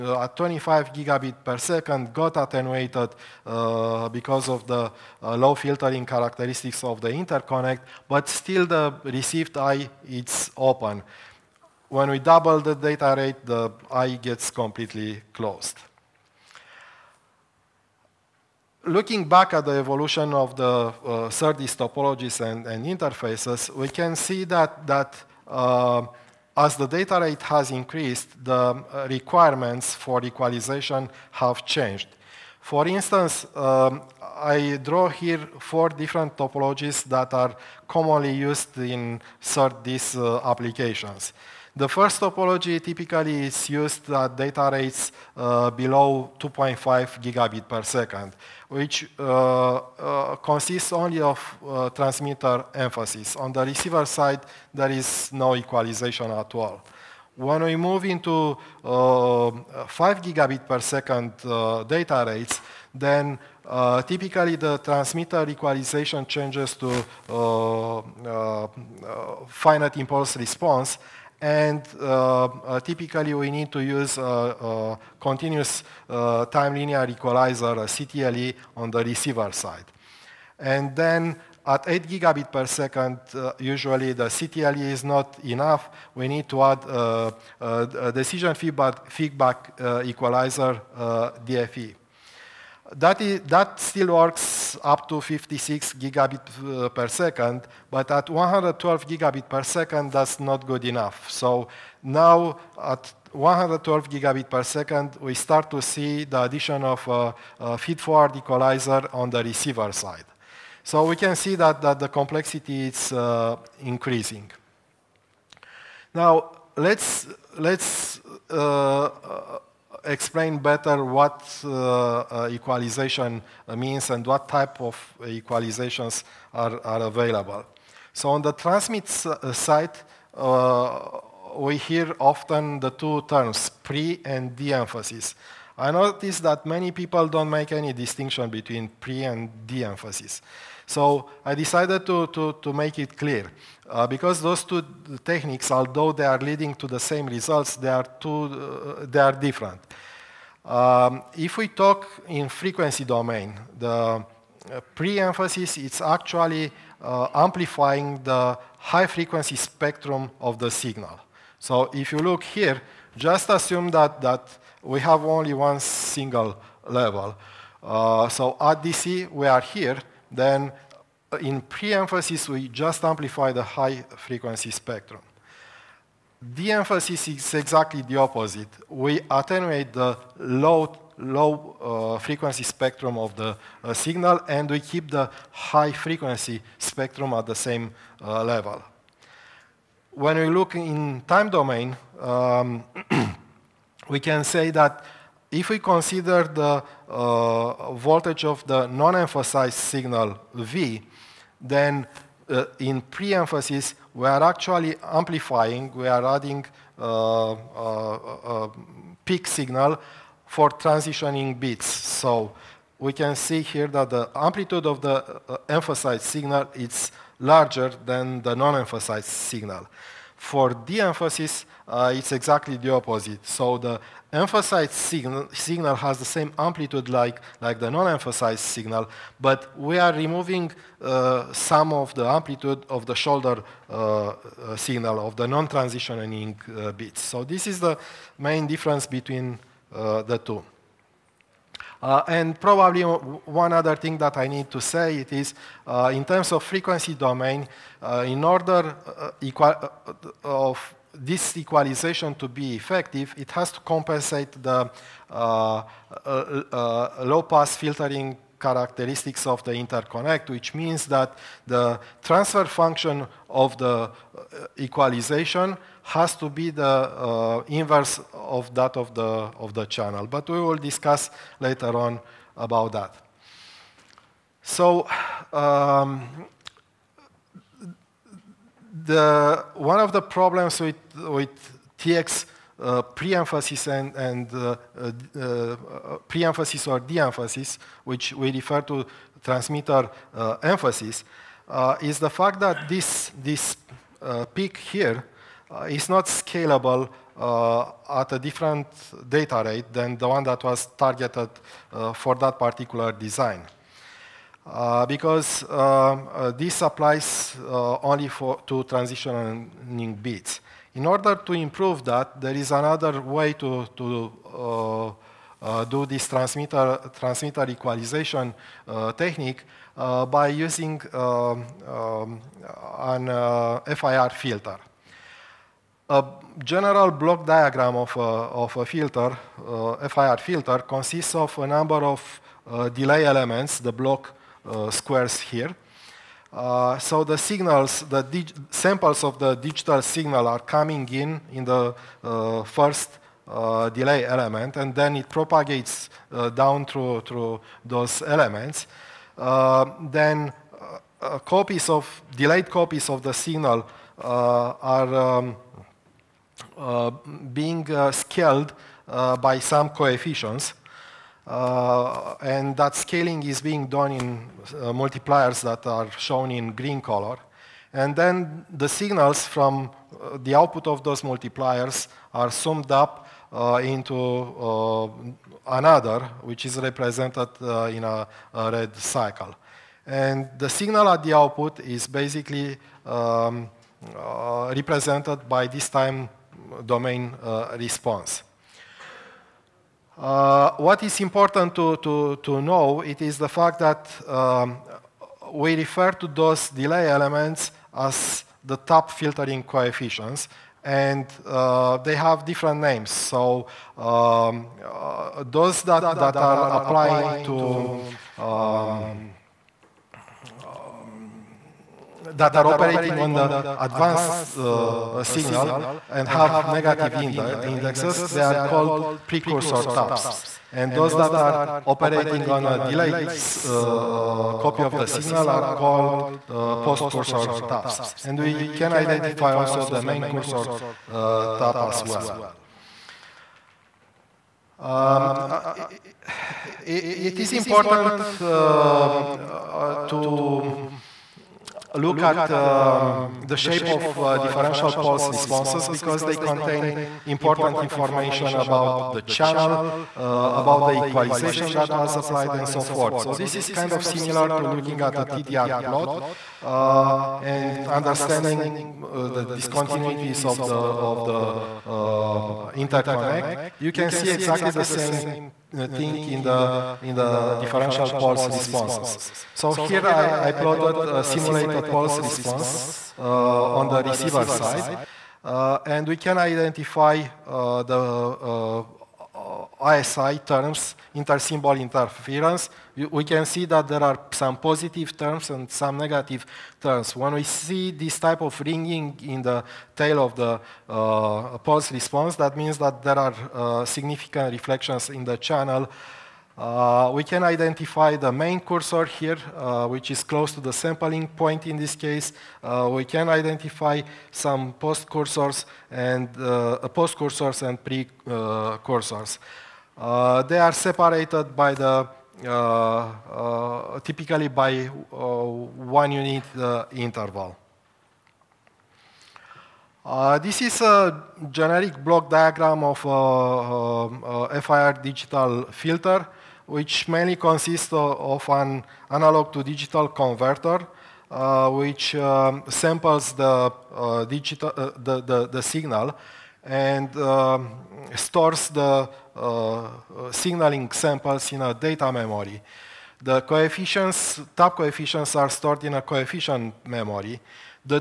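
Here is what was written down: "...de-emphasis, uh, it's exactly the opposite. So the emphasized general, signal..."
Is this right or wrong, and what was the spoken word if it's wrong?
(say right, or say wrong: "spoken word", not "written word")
wrong: "signal", not "general".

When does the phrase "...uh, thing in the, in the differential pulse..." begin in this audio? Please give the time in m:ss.
7:45.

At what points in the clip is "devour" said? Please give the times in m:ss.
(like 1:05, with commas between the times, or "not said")
not said.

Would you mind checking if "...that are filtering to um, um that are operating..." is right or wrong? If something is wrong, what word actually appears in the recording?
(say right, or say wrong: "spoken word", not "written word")
wrong: "applying", not "filtering".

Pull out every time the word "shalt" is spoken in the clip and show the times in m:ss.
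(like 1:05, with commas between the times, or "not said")
not said.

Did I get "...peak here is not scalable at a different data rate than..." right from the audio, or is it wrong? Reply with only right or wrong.
right.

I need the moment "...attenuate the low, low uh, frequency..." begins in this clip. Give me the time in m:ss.
2:59.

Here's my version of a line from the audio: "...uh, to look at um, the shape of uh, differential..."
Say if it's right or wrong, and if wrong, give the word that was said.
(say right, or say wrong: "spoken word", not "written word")
right.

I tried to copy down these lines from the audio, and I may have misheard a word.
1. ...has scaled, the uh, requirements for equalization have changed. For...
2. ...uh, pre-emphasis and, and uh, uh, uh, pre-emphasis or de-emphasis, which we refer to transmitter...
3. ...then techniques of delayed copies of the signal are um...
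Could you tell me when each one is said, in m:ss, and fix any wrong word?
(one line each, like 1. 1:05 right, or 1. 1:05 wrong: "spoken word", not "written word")
1. 0:27 wrong: "increased", not "scaled"
2. 4:42 right
3. 5:50 wrong: "copies", not "techniques".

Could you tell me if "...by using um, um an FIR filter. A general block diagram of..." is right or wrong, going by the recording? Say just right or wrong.
right.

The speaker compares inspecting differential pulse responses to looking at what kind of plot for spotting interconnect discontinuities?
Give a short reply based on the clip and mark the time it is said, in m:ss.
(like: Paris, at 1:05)
TDR plot, at 7:35.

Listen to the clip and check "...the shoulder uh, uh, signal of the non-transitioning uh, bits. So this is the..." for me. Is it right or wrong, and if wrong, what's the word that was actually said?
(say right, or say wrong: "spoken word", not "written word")
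right.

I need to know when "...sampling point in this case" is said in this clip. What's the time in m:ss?
8:20.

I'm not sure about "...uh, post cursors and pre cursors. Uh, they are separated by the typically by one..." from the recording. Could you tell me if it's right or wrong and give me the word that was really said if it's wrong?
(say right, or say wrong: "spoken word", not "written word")
right.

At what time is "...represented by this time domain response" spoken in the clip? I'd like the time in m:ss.
6:24.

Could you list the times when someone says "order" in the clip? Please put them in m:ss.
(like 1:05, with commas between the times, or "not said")
4:08, 5:11.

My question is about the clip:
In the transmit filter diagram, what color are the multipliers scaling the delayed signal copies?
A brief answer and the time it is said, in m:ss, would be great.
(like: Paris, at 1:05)
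Green, at 6:06.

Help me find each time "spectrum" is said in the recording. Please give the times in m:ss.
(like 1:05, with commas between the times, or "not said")
2:39, 2:54, 3:02, 3:06.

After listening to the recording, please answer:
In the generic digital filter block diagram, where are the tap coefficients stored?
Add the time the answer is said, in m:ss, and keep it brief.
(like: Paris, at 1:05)
Coefficient memory, at 9:06.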